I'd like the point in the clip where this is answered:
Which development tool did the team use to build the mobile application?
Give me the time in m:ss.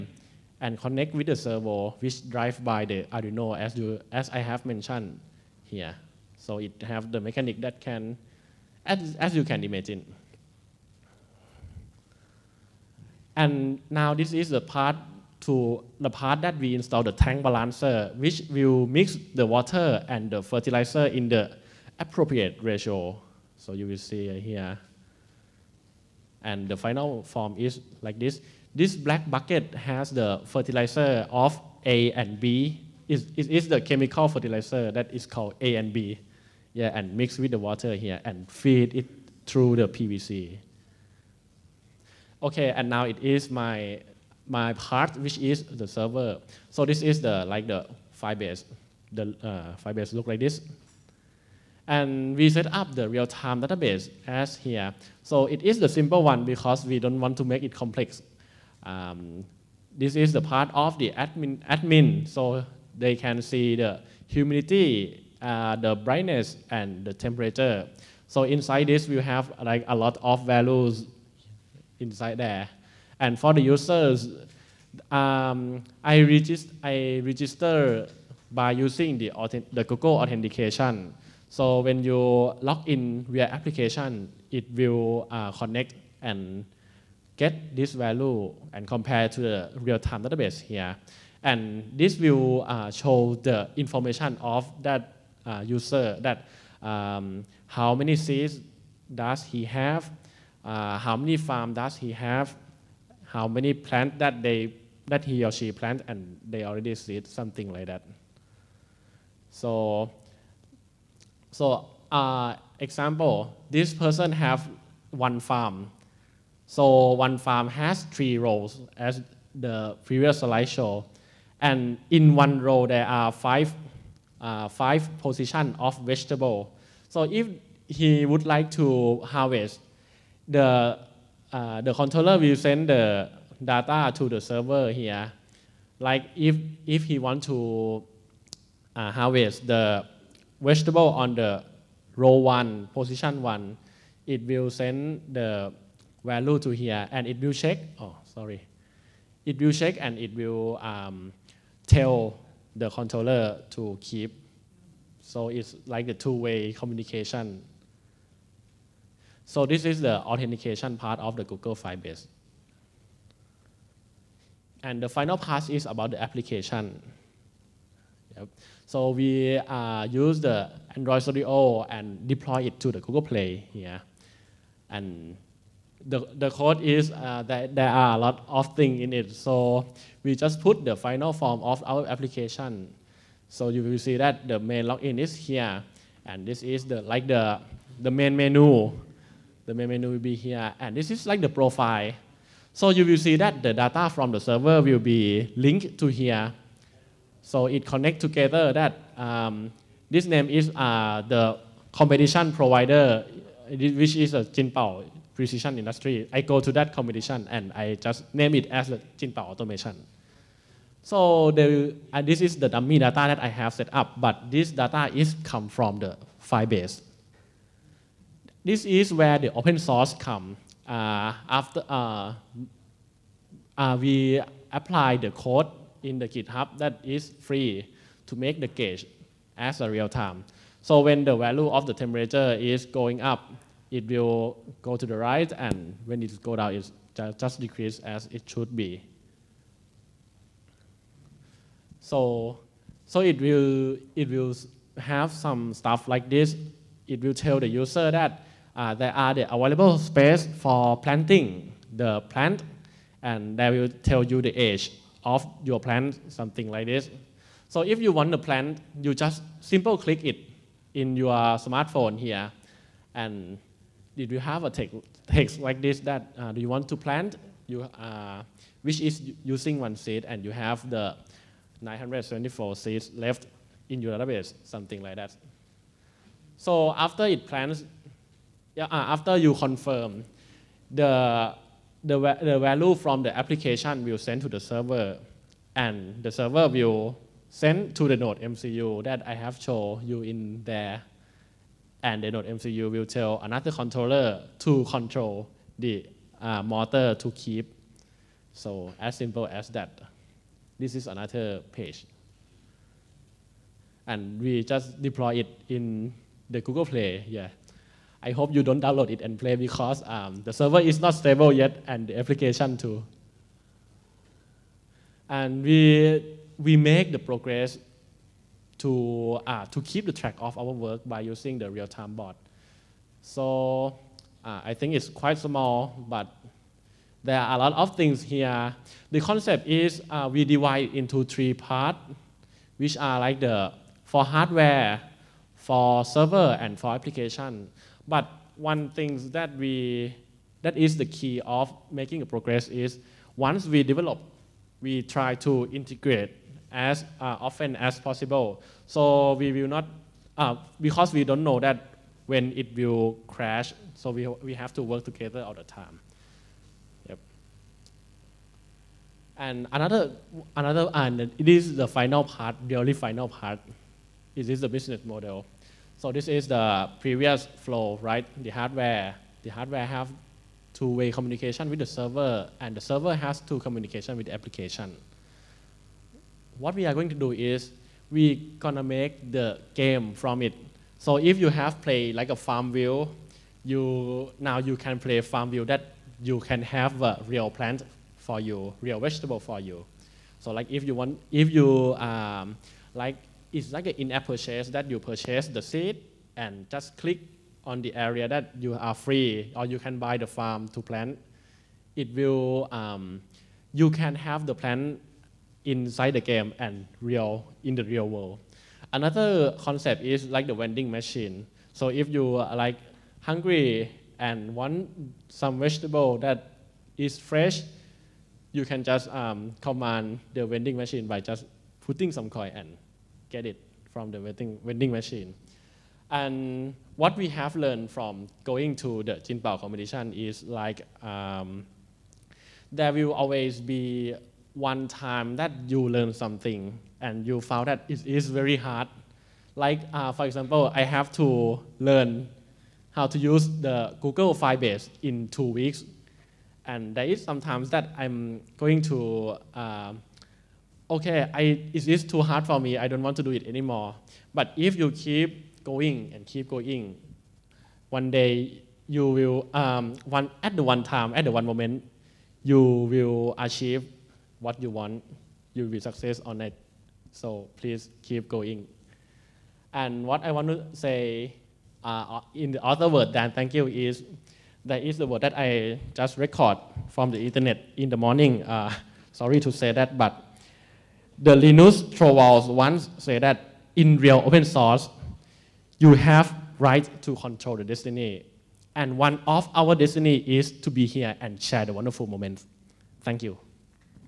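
2:50.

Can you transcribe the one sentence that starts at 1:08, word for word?
So inside this, we have like a lot of values inside there.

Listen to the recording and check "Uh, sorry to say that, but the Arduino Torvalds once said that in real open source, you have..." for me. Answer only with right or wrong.
wrong.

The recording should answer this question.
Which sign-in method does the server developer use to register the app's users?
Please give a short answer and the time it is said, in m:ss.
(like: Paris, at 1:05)
Google authentication, at 1:19.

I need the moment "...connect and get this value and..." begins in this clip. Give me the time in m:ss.
1:25.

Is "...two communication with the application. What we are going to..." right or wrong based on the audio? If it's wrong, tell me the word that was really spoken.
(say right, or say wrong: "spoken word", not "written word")
right.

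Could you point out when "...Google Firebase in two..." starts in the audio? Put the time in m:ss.
7:24.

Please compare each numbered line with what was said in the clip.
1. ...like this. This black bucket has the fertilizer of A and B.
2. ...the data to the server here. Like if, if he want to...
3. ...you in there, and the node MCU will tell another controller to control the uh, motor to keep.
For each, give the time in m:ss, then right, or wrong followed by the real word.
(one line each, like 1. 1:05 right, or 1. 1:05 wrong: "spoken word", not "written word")
1. 0:28 right
2. 2:12 right
3. 4:50 right.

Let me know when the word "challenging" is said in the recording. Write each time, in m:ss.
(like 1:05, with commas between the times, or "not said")
not said.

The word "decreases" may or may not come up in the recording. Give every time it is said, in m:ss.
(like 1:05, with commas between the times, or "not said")
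3:57.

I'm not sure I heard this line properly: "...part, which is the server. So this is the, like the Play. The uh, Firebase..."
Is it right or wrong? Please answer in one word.
wrong.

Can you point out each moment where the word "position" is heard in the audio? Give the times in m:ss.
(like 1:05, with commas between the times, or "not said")
2:05, 2:22.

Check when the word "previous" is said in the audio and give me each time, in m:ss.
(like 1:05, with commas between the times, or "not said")
2:00, 6:06.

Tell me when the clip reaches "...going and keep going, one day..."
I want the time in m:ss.
7:35.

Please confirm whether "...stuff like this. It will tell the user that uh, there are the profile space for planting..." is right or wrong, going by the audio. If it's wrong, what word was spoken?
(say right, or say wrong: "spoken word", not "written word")
wrong: "available", not "profile".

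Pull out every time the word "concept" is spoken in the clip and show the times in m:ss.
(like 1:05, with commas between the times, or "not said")
5:29, 6:49.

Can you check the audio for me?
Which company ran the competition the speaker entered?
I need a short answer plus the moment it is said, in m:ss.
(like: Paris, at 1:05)
Jinpao Precision Industry, at 3:24.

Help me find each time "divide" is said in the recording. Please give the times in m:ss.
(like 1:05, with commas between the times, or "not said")
5:30.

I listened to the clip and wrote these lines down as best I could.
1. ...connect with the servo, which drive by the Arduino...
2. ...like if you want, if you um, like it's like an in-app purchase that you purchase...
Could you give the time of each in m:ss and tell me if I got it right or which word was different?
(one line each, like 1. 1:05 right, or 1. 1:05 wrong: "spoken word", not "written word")
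1. 0:00 right
2. 6:30 right.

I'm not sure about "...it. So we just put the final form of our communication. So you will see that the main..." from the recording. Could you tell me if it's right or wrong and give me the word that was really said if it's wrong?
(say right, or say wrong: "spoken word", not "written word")
wrong: "application", not "communication".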